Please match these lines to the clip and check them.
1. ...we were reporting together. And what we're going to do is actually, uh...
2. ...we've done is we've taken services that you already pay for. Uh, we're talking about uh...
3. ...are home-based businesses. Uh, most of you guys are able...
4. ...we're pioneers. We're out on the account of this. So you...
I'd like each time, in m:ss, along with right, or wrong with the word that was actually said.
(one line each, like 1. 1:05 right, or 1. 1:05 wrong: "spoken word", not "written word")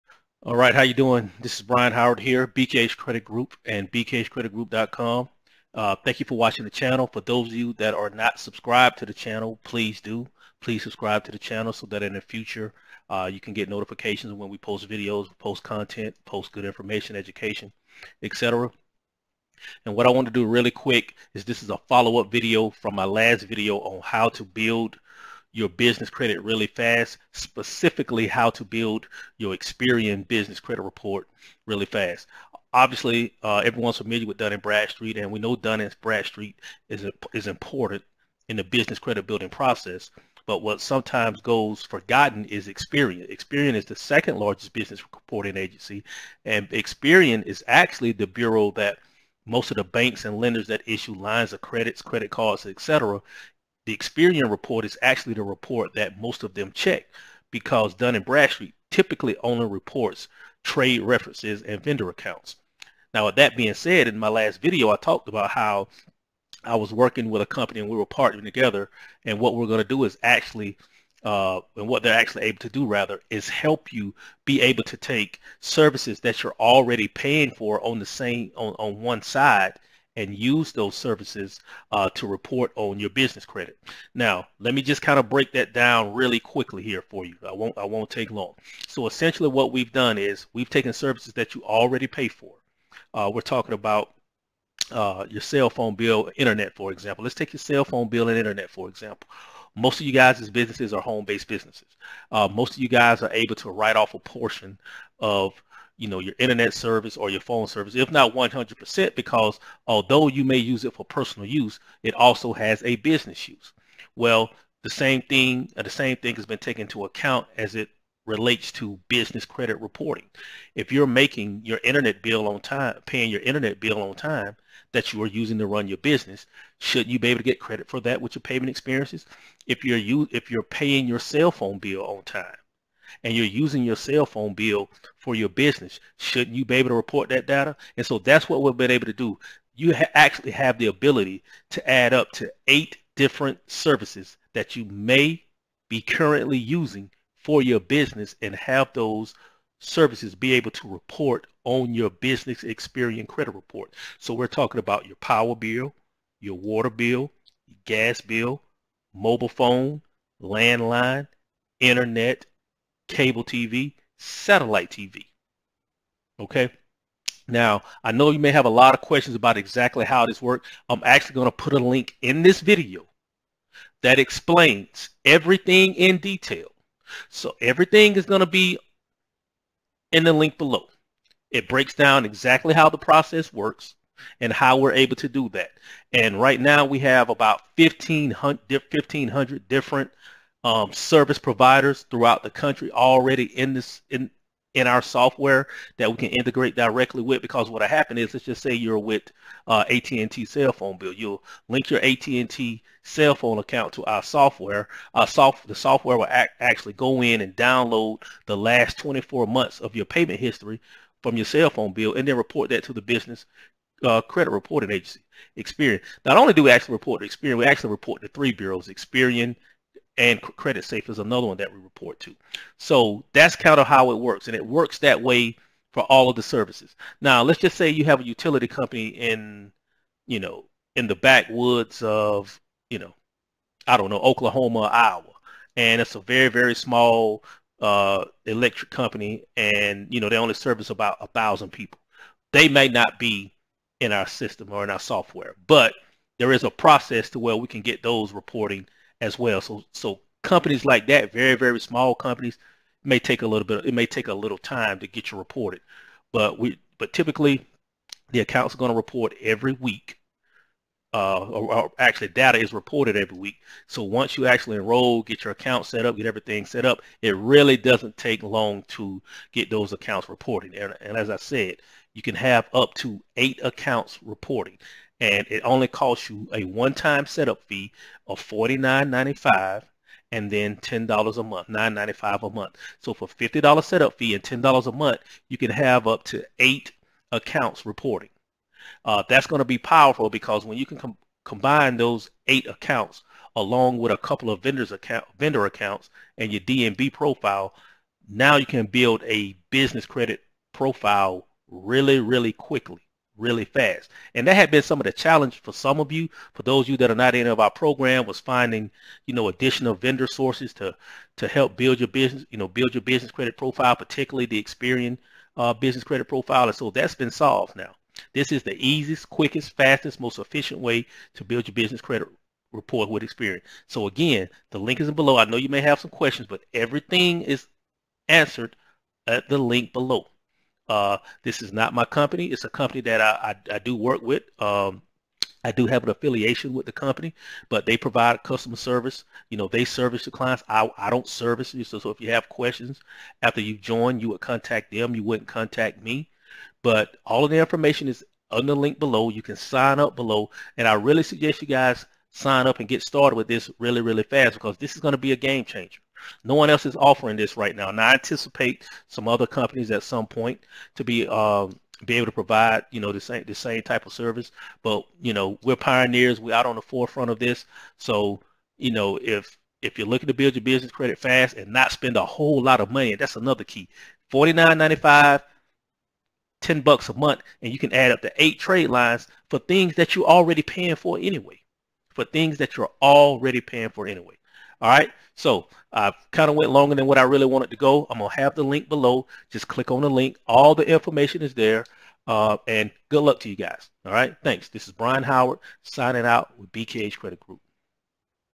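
1. 1:07 wrong: "partnering", not "reporting"
2. 1:29 right
3. 1:40 right
4. 6:05 wrong: "forefront", not "account".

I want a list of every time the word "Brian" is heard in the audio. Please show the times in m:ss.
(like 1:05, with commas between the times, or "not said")
0:01, 6:34.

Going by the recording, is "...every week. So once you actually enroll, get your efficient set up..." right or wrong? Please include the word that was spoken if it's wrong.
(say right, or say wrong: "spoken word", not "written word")
wrong: "account", not "efficient".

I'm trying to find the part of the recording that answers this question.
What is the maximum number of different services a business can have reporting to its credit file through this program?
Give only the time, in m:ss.
2:22.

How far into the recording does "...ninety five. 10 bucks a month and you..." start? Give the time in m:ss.
6:14.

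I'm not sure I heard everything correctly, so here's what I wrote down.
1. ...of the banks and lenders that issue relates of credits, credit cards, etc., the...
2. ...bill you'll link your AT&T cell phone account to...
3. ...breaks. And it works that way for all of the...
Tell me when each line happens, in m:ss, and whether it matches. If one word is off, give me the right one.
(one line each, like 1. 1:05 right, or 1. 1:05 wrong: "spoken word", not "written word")
1. 0:49 wrong: "lines", not "relates"
2. 3:20 right
3. 3:44 wrong: "works", not "breaks".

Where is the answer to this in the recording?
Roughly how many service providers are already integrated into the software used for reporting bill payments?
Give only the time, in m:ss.
3:08.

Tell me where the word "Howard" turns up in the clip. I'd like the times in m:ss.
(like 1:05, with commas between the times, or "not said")
0:01, 6:35.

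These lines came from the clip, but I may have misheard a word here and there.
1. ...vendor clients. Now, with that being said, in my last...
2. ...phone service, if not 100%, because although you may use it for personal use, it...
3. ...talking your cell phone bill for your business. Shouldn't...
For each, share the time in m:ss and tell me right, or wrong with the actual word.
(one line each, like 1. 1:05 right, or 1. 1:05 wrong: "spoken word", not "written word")
1. 1:01 wrong: "accounts", not "clients"
2. 1:47 right
3. 2:13 wrong: "using", not "talking".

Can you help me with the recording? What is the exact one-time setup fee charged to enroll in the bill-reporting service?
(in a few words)
$49.95.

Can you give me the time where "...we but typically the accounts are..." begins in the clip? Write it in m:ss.
4:16.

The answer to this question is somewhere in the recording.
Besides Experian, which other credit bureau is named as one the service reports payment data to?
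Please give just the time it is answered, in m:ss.
3:40.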